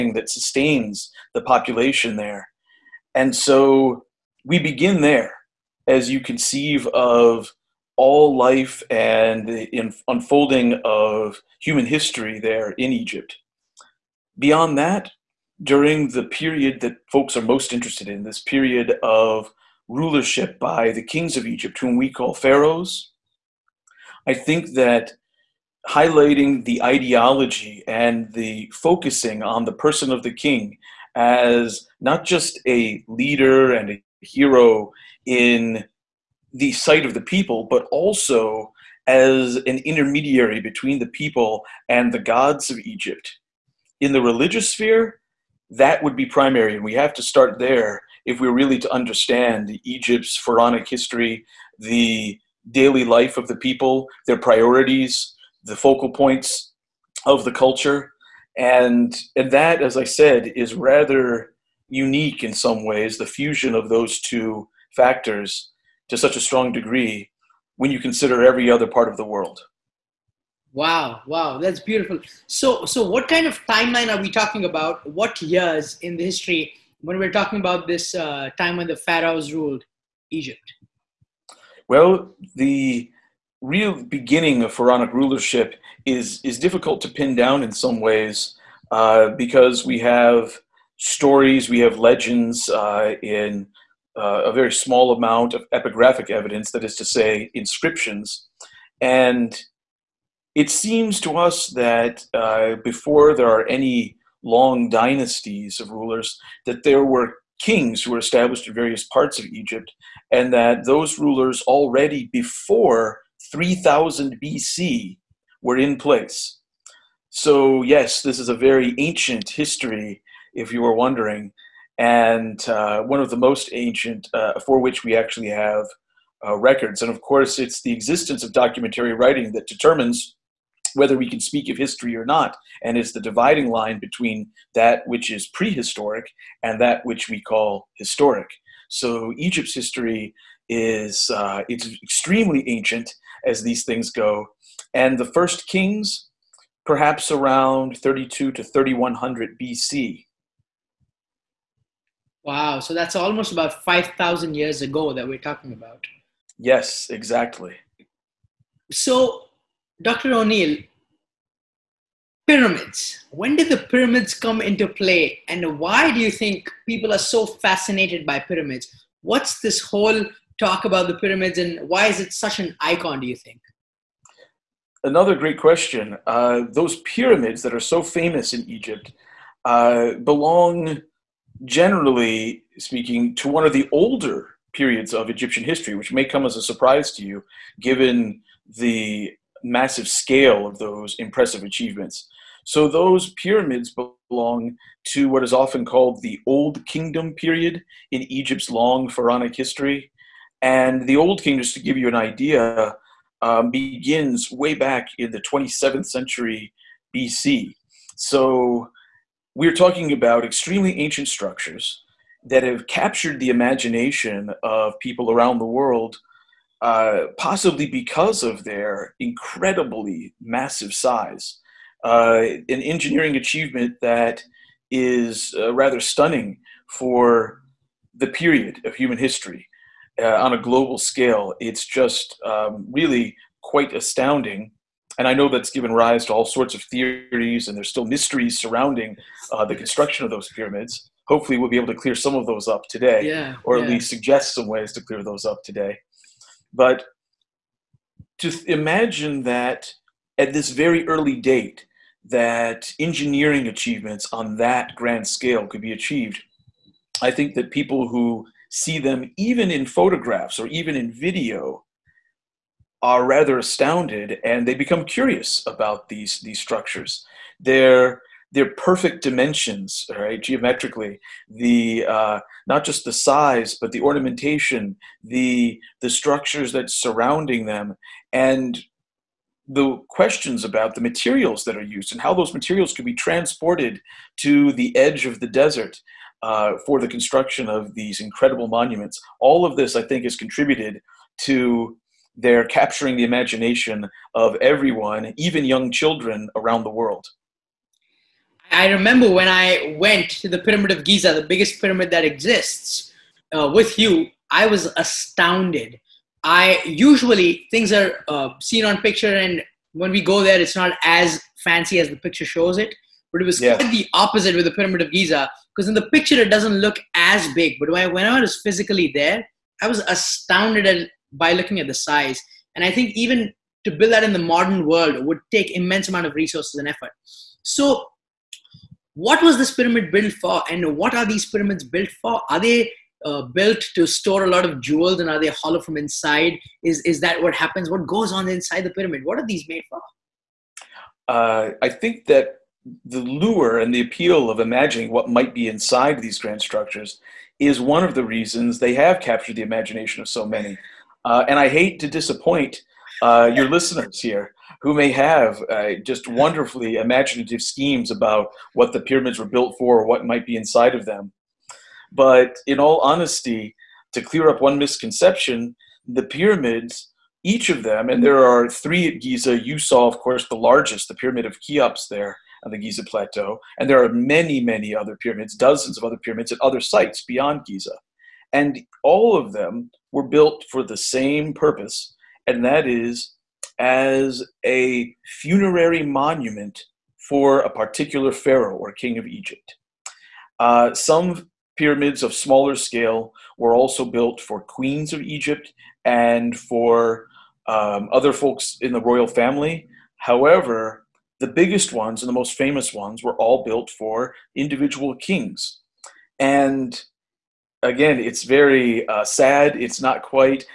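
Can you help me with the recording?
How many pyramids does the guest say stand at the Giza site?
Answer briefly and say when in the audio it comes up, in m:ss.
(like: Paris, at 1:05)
3, at 6:08.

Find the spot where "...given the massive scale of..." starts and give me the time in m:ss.
3:07.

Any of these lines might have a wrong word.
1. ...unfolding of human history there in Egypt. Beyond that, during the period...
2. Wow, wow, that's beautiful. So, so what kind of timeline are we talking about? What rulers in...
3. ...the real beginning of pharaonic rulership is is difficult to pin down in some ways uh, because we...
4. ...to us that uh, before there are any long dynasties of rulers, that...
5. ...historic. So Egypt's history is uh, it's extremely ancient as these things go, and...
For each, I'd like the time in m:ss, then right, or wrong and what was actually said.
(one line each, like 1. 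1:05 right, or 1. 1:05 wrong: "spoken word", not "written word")
1. 0:10 right
2. 1:10 wrong: "years", not "rulers"
3. 1:22 right
4. 1:41 right
5. 2:17 right.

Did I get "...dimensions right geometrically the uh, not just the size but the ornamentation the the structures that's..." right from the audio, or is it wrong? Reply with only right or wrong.
right.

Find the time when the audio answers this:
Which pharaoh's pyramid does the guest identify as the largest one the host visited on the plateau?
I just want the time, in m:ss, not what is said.
6:11.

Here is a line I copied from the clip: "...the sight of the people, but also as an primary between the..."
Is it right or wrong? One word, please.
wrong.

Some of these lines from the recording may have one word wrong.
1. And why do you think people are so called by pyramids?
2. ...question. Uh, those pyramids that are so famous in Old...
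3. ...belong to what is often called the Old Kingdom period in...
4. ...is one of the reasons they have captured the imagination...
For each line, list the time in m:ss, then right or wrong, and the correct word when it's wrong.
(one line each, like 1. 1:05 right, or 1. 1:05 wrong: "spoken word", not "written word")
1. 2:45 wrong: "fascinated", not "called"
2. 2:55 wrong: "Egypt", not "Old"
3. 3:14 right
4. 5:47 right.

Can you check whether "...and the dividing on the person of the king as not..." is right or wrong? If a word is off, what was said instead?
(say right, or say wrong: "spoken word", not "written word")
wrong: "focusing", not "dividing".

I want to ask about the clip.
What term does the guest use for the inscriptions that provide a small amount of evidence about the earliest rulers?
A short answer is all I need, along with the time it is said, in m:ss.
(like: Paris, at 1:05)
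epigraphic evidence, at 1:35.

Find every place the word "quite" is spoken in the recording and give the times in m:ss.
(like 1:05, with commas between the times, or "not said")
3:53, 5:13, 6:50.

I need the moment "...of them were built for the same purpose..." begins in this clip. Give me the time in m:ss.
6:19.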